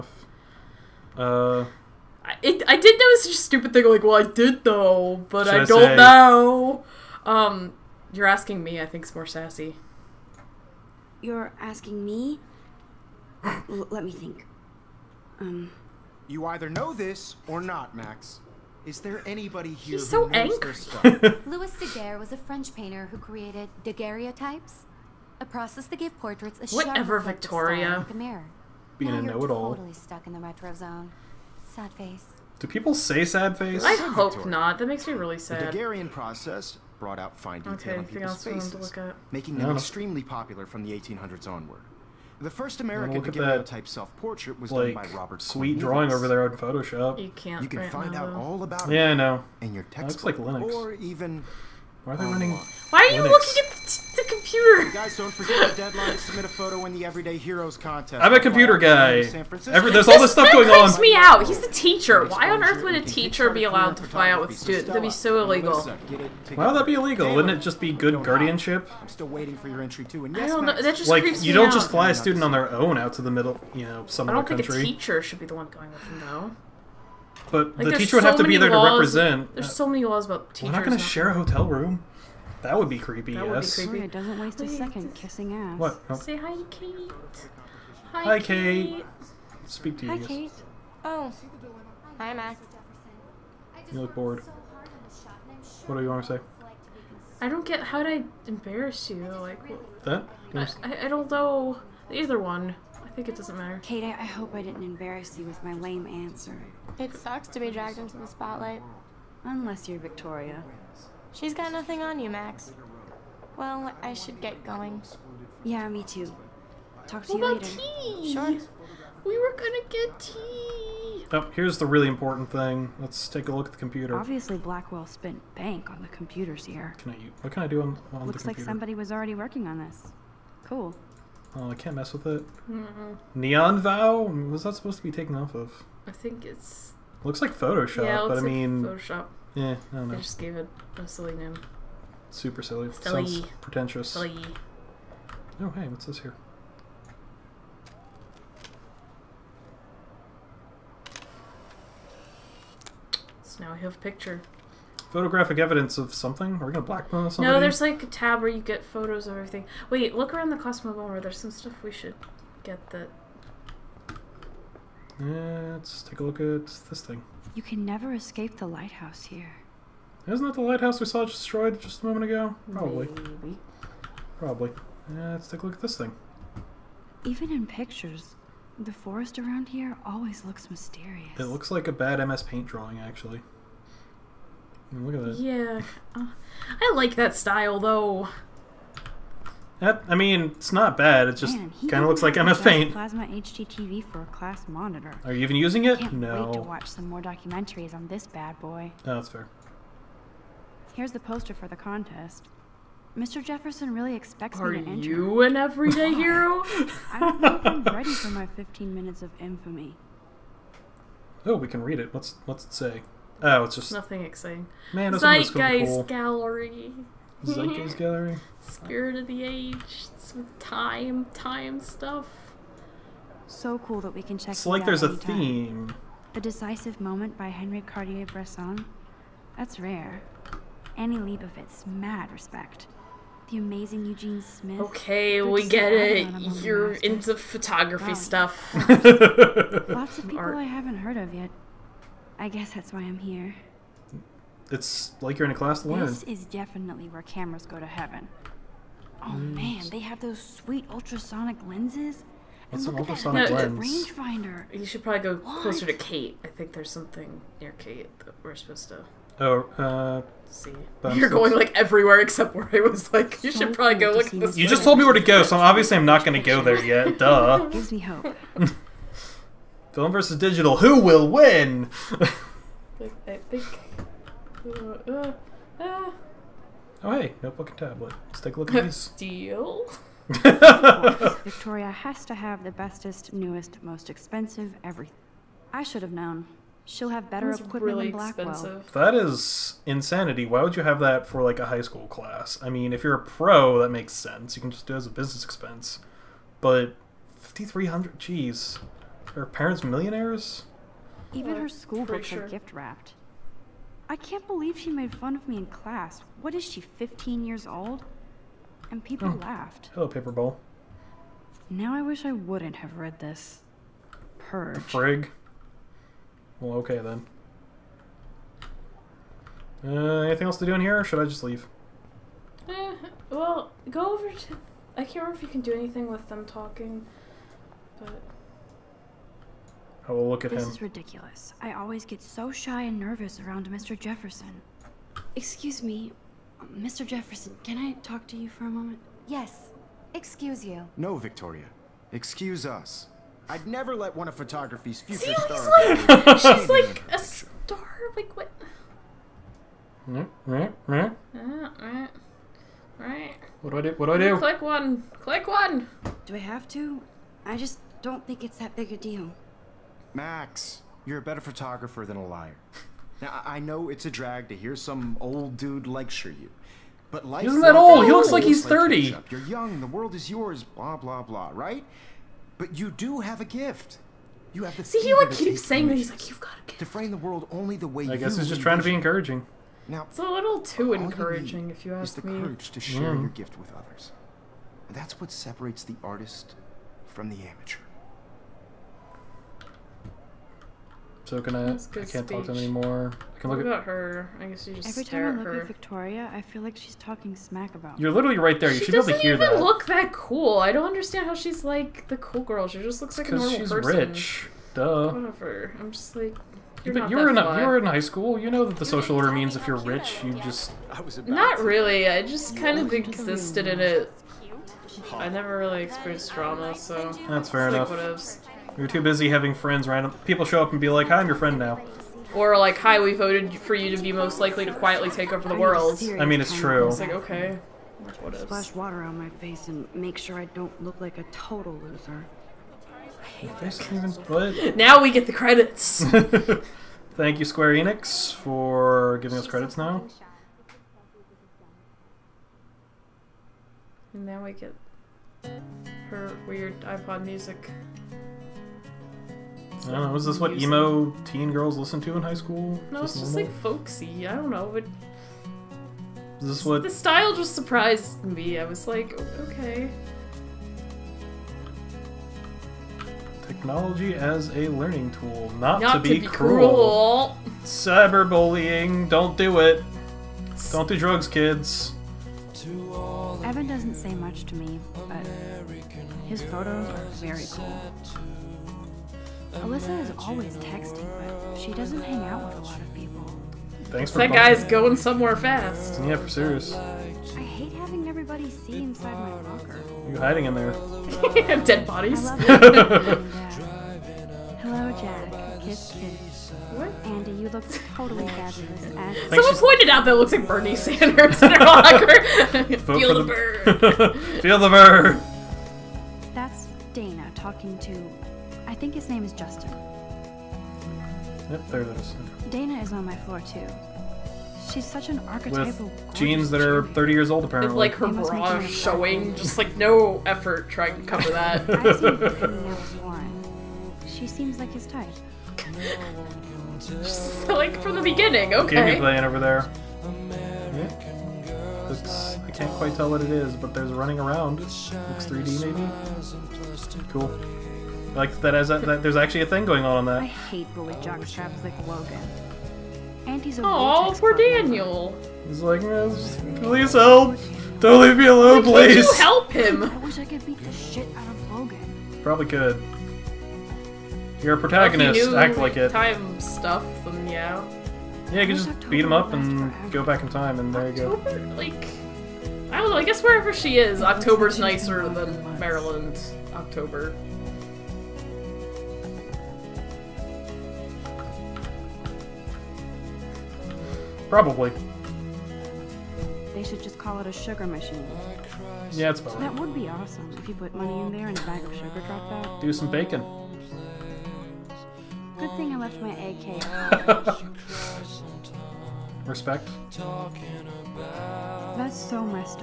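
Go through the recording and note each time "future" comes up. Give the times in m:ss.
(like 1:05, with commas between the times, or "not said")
5:44.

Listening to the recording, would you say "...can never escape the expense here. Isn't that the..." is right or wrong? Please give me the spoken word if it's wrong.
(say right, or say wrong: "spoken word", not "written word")
wrong: "lighthouse", not "expense".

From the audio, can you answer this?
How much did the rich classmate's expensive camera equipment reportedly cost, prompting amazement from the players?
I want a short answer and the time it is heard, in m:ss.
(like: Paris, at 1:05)
5300, at 4:57.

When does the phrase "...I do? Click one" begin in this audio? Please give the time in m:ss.
5:54.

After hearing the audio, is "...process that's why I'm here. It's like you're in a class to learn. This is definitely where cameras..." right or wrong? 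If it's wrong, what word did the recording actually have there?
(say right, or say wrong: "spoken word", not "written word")
wrong: "guess", not "process".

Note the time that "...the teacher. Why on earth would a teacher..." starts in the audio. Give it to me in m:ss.
1:01.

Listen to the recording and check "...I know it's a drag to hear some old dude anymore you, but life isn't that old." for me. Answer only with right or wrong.
wrong.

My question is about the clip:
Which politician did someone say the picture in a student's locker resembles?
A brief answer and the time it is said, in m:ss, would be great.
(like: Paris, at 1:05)
Bernie Sanders, at 8:20.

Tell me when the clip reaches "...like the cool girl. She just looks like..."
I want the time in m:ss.
6:41.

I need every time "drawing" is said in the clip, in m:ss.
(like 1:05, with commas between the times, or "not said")
0:45, 3:02.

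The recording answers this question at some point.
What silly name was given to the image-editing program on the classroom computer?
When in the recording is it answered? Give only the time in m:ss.
2:13.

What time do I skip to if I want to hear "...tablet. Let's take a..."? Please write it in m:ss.
4:37.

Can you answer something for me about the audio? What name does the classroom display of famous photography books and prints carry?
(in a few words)
Zeitgeist Gallery.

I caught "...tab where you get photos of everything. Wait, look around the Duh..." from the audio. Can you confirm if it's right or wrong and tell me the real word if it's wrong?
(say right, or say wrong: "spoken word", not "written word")
wrong: "Cosmo", not "Duh".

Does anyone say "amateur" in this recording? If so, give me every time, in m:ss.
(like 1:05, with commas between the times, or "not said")
6:27.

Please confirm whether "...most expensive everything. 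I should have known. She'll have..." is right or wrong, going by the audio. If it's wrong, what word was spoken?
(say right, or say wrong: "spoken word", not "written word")
right.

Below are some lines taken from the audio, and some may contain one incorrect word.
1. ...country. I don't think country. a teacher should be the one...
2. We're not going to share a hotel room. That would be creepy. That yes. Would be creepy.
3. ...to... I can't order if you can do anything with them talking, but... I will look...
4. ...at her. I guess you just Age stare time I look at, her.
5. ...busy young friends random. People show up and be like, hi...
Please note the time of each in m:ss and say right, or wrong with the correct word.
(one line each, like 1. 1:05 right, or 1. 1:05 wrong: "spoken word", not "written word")
1. 1:14 right
2. 1:20 right
3. 5:24 wrong: "remember", not "order"
4. 6:33 wrong: "Every", not "Age"
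5. 6:59 wrong: "having", not "young".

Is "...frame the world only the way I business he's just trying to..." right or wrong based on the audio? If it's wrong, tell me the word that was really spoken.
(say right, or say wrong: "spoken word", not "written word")
wrong: "guess", not "business".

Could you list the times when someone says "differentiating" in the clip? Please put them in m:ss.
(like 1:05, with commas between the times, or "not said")
not said.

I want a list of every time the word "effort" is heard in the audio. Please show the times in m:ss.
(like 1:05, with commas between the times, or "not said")
8:40.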